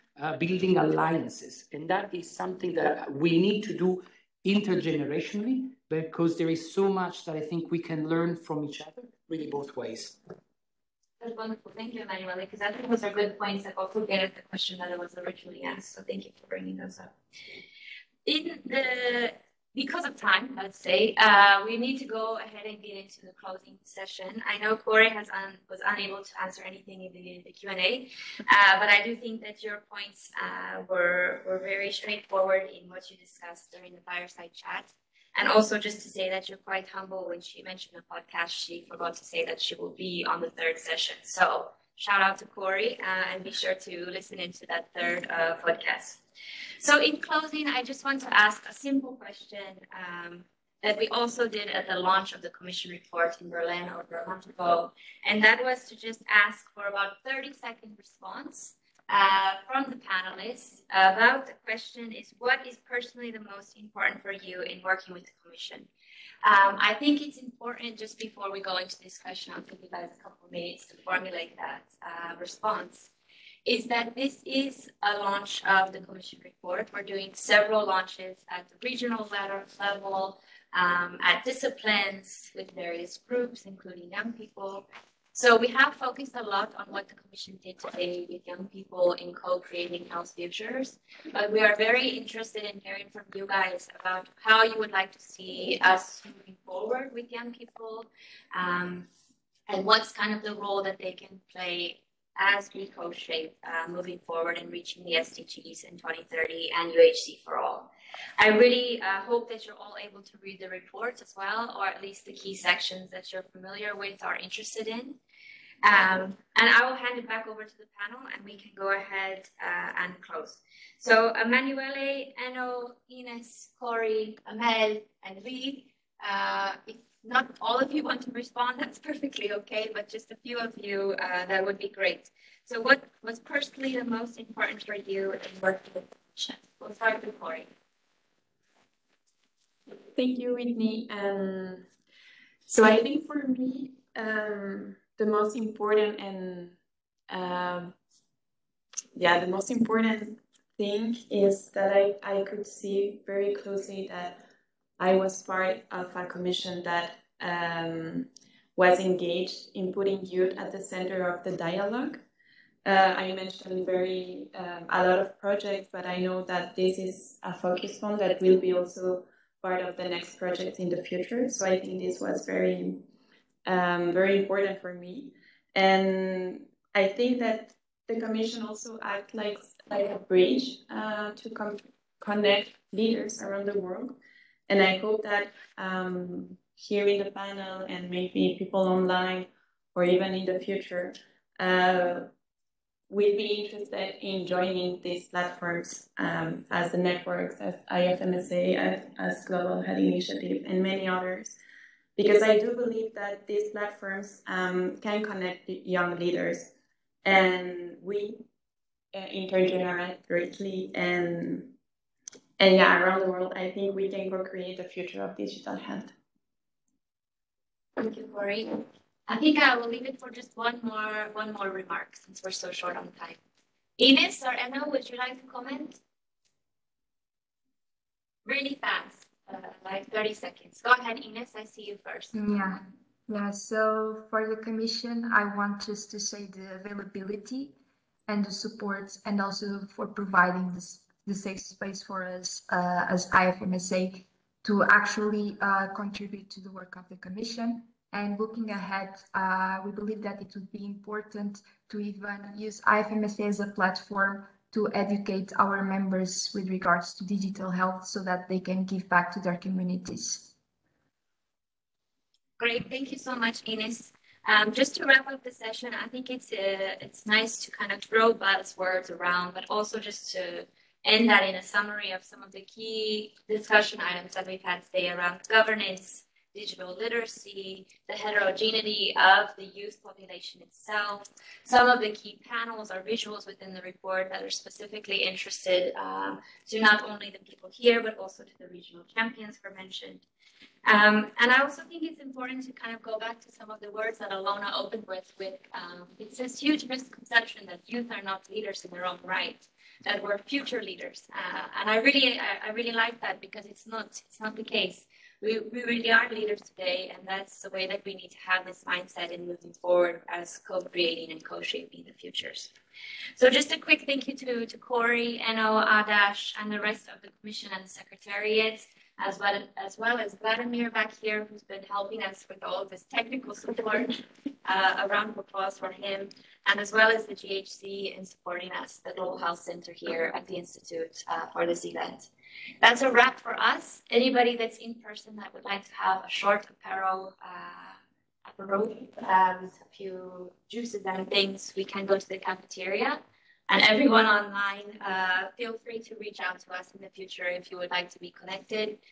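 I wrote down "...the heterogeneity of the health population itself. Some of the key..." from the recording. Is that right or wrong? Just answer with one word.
wrong.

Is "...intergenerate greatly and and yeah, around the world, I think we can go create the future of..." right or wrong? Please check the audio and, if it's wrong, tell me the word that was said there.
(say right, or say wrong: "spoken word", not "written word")
right.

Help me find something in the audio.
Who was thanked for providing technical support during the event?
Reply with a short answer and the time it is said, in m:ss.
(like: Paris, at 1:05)
Vladimir, at 5:20.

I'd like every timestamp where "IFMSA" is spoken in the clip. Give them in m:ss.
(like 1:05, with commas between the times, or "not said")
3:17, 4:03, 4:12.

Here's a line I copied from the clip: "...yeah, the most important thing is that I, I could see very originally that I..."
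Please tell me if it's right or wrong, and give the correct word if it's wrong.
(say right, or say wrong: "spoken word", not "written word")
wrong: "closely", not "originally".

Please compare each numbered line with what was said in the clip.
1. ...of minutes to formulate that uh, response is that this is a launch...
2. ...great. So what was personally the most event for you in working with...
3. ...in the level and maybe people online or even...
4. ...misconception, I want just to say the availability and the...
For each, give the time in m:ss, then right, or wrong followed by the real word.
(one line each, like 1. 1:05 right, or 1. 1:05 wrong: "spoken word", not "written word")
1. 1:10 right
2. 2:11 wrong: "important", not "event"
3. 3:07 wrong: "panel", not "level"
4. 3:54 wrong: "commission", not "misconception".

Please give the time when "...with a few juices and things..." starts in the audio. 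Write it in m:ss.
5:39.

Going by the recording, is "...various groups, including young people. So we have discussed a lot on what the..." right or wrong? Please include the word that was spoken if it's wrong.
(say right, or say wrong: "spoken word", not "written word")
wrong: "focused", not "discussed".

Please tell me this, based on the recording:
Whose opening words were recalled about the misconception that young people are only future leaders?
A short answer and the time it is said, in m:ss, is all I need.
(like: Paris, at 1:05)
Ilona, at 4:54.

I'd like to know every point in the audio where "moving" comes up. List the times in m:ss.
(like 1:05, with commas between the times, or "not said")
1:36, 1:43, 5:09.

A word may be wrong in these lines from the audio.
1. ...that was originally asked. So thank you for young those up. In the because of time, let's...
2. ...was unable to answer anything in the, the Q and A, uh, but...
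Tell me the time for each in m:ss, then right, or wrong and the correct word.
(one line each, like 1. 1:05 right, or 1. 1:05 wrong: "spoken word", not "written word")
1. 0:14 wrong: "bringing", not "young"
2. 0:25 right.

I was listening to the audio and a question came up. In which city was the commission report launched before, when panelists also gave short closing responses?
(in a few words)
Berlin.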